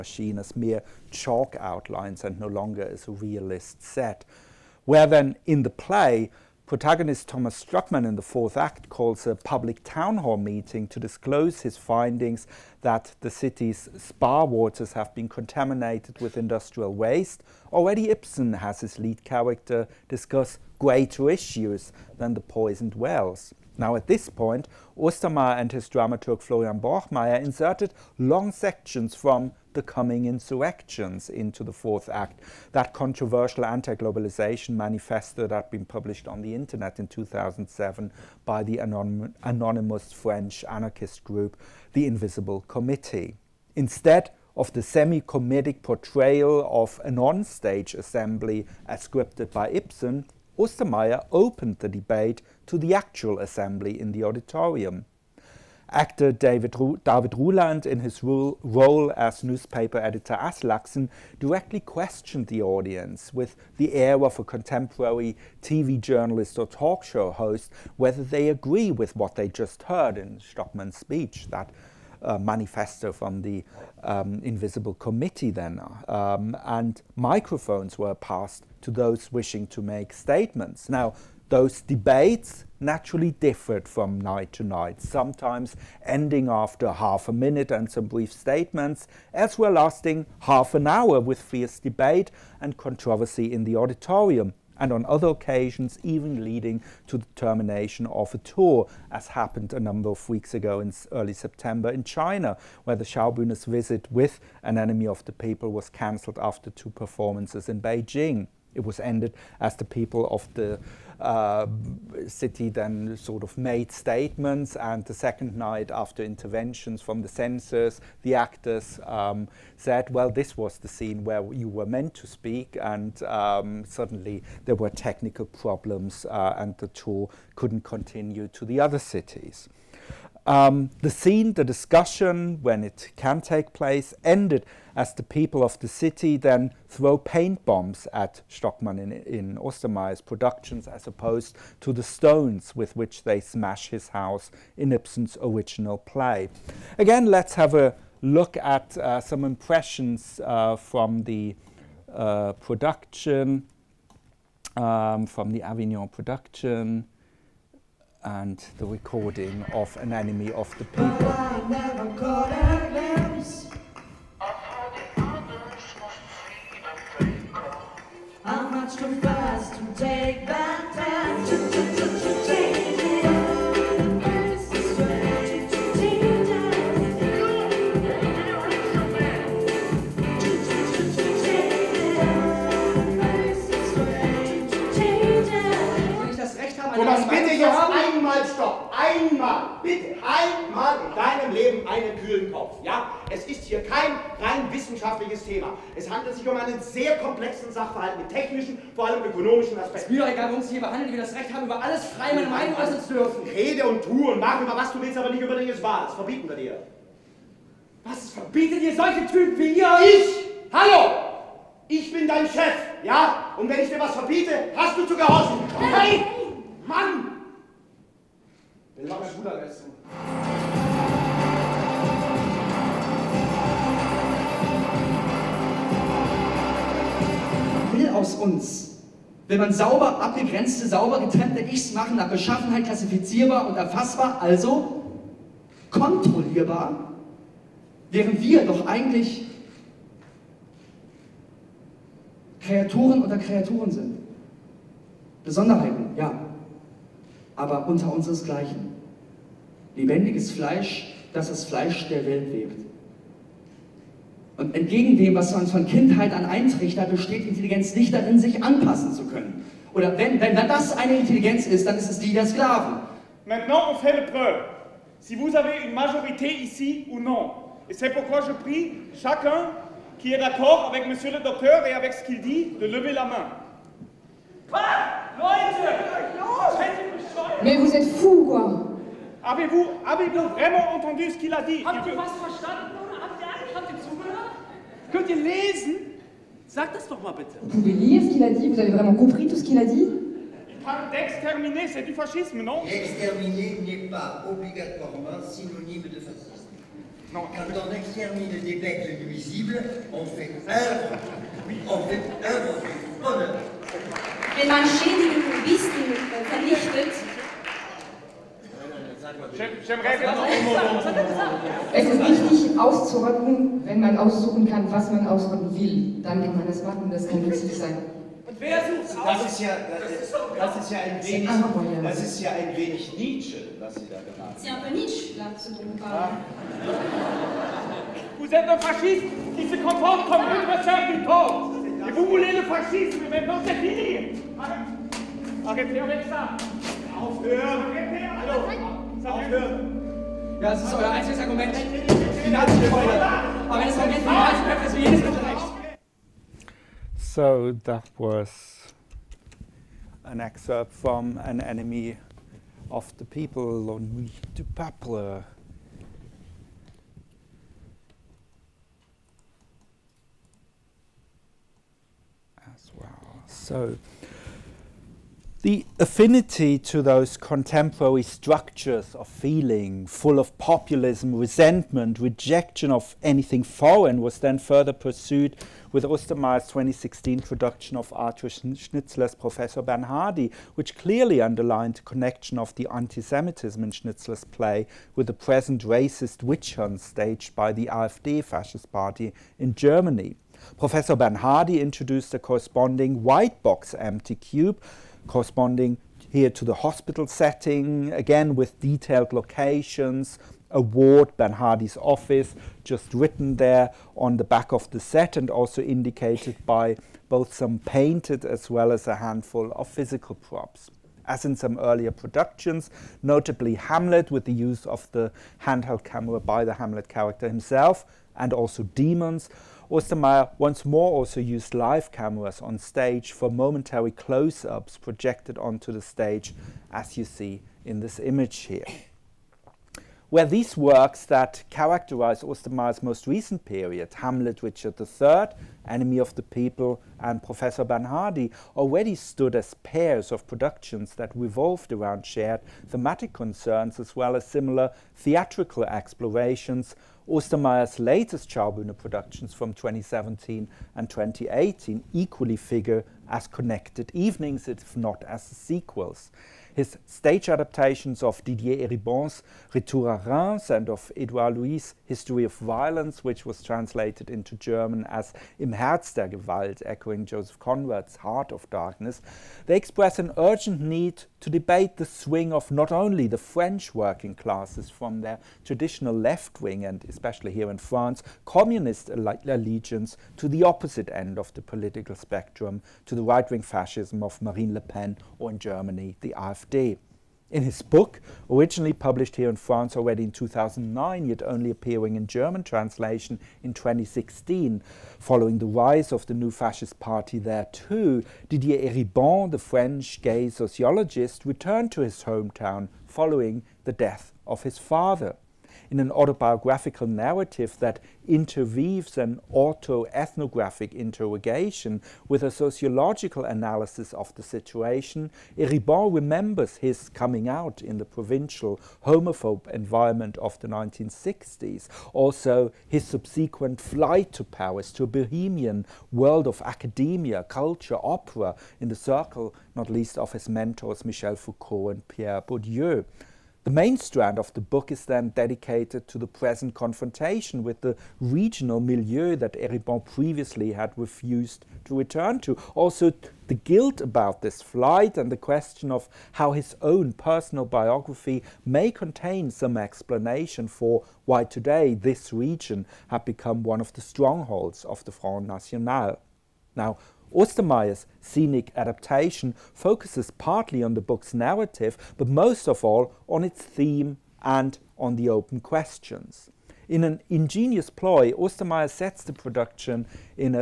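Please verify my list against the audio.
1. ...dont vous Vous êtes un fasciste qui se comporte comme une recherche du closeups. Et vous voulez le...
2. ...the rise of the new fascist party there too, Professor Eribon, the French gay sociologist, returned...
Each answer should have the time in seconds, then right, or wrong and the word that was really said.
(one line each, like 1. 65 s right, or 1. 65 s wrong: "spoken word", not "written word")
1. 325 s wrong: "corps", not "closeups"
2. 495 s wrong: "Didier", not "Professor".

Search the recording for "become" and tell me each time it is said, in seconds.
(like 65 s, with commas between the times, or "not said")
553 s.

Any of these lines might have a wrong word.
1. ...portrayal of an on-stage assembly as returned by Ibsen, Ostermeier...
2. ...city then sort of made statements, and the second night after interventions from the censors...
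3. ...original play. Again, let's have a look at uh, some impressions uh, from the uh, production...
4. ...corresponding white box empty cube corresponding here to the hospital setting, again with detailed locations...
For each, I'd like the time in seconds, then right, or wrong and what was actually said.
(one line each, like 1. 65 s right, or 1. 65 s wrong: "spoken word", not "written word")
1. 45 s wrong: "scripted", not "returned"
2. 112 s right
3. 145 s right
4. 392 s right.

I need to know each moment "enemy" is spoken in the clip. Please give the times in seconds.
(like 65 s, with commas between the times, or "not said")
104 s, 160 s, 351 s, 435 s.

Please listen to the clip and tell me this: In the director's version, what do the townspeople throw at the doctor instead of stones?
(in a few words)
Paint bombs.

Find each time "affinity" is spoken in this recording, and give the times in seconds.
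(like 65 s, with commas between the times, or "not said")
365 s.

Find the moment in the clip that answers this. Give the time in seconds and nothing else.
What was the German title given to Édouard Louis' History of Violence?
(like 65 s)
465 s.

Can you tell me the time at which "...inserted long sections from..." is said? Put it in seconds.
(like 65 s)
27 s.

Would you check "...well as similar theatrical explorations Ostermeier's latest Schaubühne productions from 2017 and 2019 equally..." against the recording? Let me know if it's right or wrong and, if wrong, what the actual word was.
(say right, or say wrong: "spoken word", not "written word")
wrong: "2018", not "2019".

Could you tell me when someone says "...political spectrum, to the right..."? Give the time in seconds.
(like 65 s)
481 s.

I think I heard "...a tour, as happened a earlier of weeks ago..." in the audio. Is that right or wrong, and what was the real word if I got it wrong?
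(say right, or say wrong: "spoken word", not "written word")
wrong: "number", not "earlier".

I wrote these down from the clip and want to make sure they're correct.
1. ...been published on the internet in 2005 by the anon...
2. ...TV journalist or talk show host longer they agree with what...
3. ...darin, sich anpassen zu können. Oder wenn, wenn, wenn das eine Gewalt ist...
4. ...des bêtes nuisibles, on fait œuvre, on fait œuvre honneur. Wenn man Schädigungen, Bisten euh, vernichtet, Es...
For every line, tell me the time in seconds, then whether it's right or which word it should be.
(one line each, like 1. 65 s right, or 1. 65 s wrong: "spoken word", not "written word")
1. 35 s wrong: "2007", not "2005"
2. 65 s wrong: "whether", not "longer"
3. 258 s wrong: "Intelligenz", not "Gewalt"
4. 298 s right.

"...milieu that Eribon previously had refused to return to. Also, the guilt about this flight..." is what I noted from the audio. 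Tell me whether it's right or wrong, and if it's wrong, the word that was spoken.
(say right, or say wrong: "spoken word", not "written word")
right.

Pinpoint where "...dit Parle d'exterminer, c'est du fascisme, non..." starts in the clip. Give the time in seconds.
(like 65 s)
289 s.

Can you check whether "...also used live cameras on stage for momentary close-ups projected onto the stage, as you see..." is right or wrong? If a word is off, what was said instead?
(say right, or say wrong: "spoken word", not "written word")
right.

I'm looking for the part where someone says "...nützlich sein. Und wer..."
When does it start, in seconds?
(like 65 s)
317 s.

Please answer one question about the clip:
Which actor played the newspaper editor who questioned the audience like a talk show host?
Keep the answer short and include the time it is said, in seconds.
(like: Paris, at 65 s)
David Ruland, at 57 s.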